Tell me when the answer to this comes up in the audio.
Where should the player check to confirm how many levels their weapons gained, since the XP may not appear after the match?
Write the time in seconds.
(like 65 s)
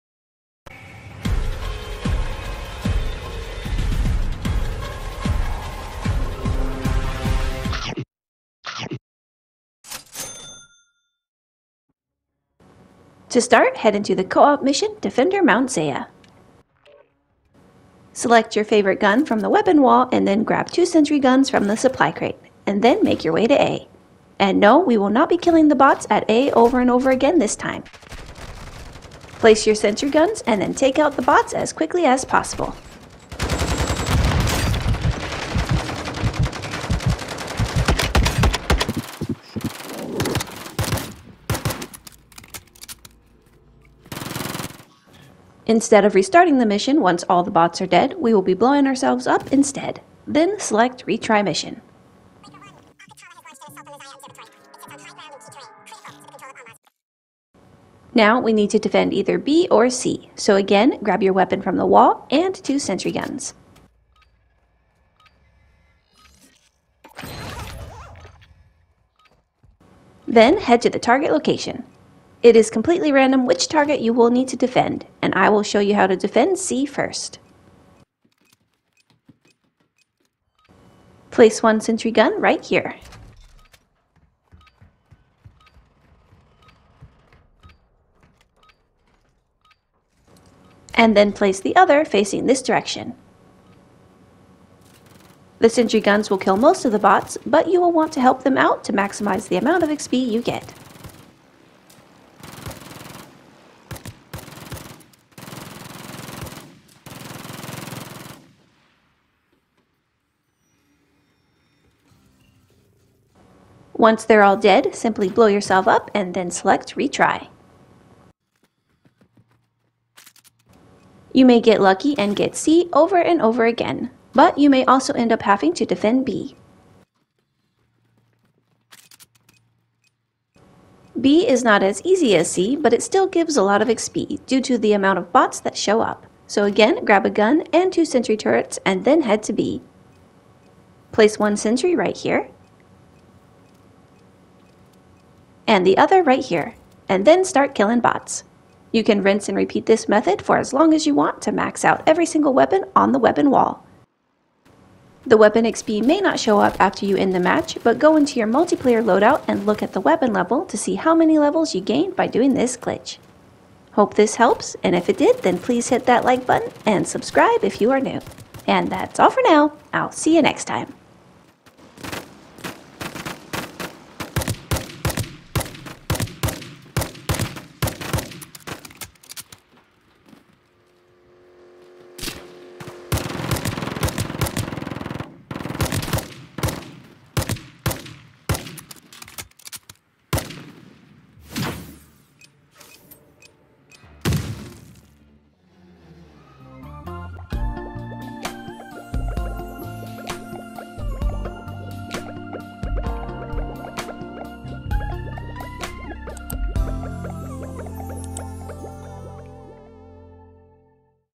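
158 s.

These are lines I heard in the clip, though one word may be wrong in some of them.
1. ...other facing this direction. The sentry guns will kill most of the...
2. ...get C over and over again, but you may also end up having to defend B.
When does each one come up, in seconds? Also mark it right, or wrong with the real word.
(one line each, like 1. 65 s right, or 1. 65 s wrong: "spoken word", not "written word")
1. 91 s right
2. 122 s right.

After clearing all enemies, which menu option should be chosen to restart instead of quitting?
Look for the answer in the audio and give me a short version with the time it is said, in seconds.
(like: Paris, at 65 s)
Retry Mission, at 51 s.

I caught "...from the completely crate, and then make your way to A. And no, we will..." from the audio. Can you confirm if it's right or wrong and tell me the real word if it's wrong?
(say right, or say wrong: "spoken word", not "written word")
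wrong: "supply", not "completely".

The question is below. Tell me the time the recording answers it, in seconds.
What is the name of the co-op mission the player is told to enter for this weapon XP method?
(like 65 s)
14 s.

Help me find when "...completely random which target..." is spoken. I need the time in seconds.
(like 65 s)
72 s.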